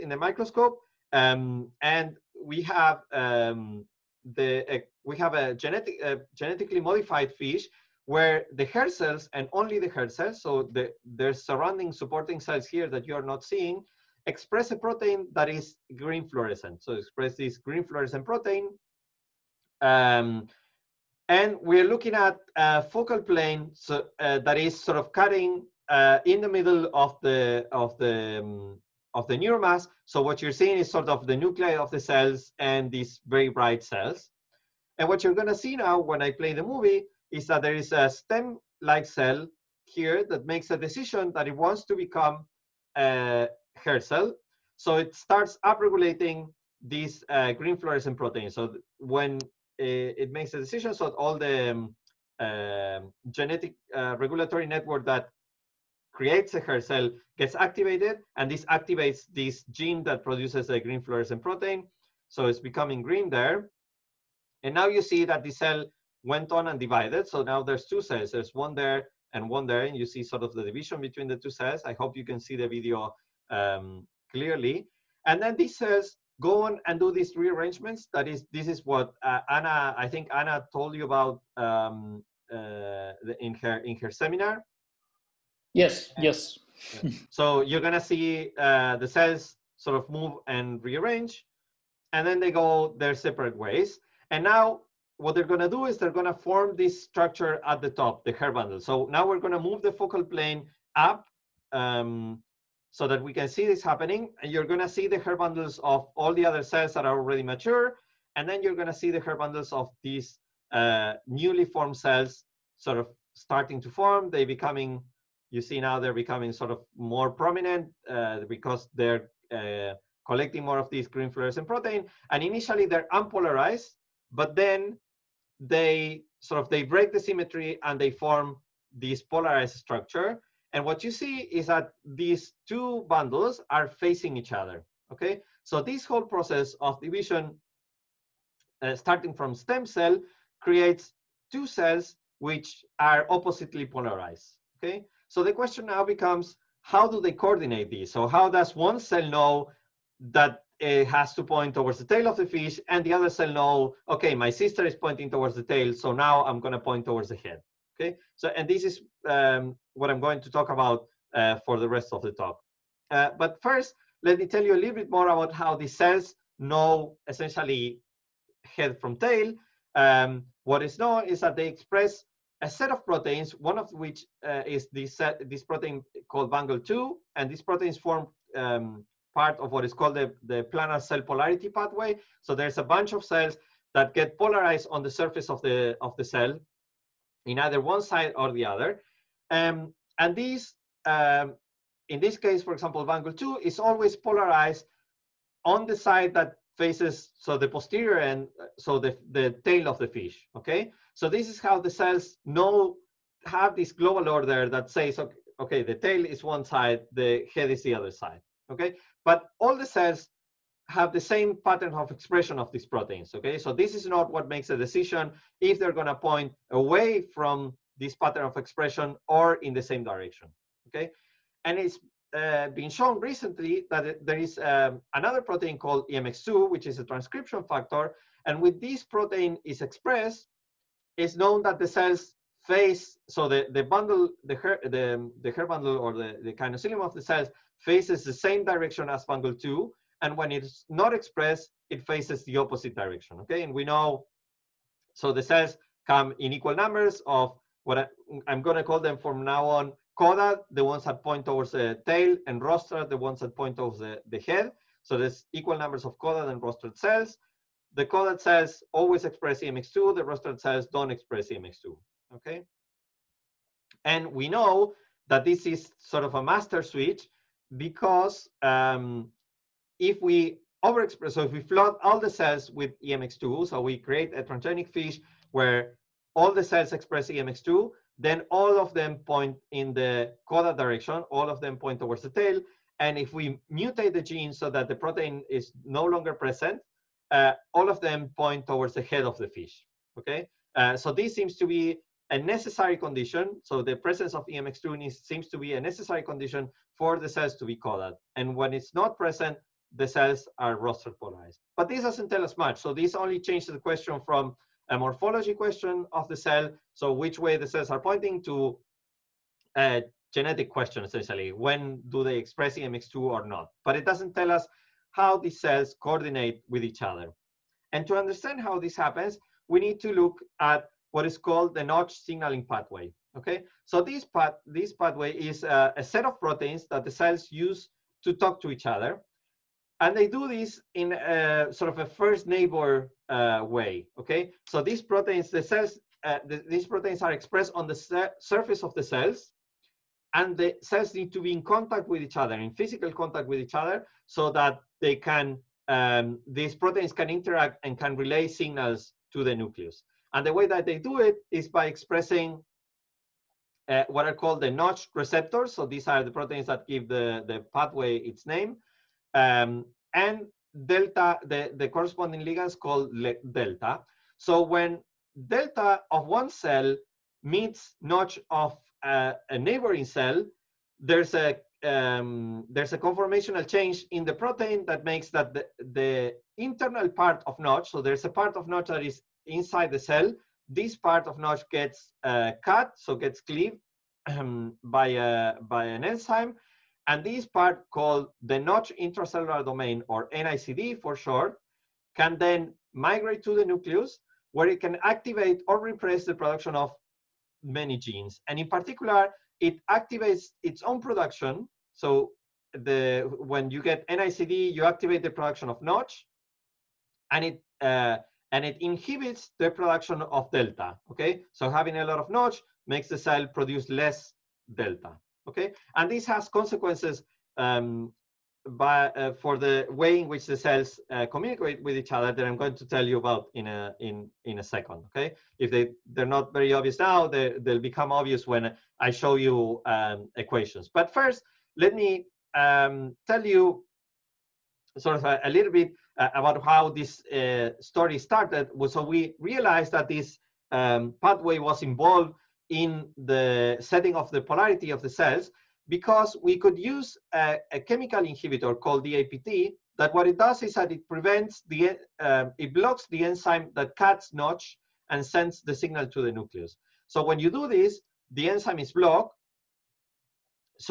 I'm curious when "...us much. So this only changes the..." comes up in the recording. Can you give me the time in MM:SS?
05:02.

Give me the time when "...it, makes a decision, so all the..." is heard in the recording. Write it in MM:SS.
00:50.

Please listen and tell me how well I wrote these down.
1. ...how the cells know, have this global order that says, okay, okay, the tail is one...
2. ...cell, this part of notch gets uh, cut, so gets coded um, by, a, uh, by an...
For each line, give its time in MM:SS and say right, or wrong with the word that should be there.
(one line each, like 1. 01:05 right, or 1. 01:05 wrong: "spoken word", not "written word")
1. 03:21 right
2. 06:19 wrong: "cleaved", not "coded".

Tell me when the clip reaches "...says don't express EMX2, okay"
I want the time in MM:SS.
04:20.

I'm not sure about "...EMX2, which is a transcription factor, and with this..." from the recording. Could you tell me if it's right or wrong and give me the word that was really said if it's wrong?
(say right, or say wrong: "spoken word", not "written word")
right.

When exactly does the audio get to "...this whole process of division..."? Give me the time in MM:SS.
02:15.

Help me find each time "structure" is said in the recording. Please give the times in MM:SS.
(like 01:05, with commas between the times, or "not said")
01:37, 02:09.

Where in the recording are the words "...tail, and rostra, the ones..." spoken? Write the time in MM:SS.
04:12.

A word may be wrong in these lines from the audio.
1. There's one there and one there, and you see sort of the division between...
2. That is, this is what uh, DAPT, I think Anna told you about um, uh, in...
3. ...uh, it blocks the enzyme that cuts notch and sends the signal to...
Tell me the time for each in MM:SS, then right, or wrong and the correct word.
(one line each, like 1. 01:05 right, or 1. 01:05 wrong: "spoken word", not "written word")
1. 01:08 right
2. 01:18 wrong: "Anna", not "DAPT"
3. 07:32 right.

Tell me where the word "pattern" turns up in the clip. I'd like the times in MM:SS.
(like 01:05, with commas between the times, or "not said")
03:31, 03:38.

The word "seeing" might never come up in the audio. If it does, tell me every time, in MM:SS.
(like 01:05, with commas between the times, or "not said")
00:13, 00:30.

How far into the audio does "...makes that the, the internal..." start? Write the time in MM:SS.
06:15.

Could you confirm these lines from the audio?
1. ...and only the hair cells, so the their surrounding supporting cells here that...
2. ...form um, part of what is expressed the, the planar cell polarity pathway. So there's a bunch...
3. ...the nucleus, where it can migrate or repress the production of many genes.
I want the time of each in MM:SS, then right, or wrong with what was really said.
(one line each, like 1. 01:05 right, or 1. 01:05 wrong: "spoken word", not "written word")
1. 00:09 right
2. 02:57 wrong: "called", not "expressed"
3. 06:33 wrong: "activate", not "migrate".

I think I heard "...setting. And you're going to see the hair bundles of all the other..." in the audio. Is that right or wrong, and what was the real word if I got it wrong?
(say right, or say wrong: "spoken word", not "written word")
wrong: "happening", not "setting".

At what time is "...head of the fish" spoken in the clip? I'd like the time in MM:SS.
04:49.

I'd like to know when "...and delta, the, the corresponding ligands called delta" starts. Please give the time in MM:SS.
06:00.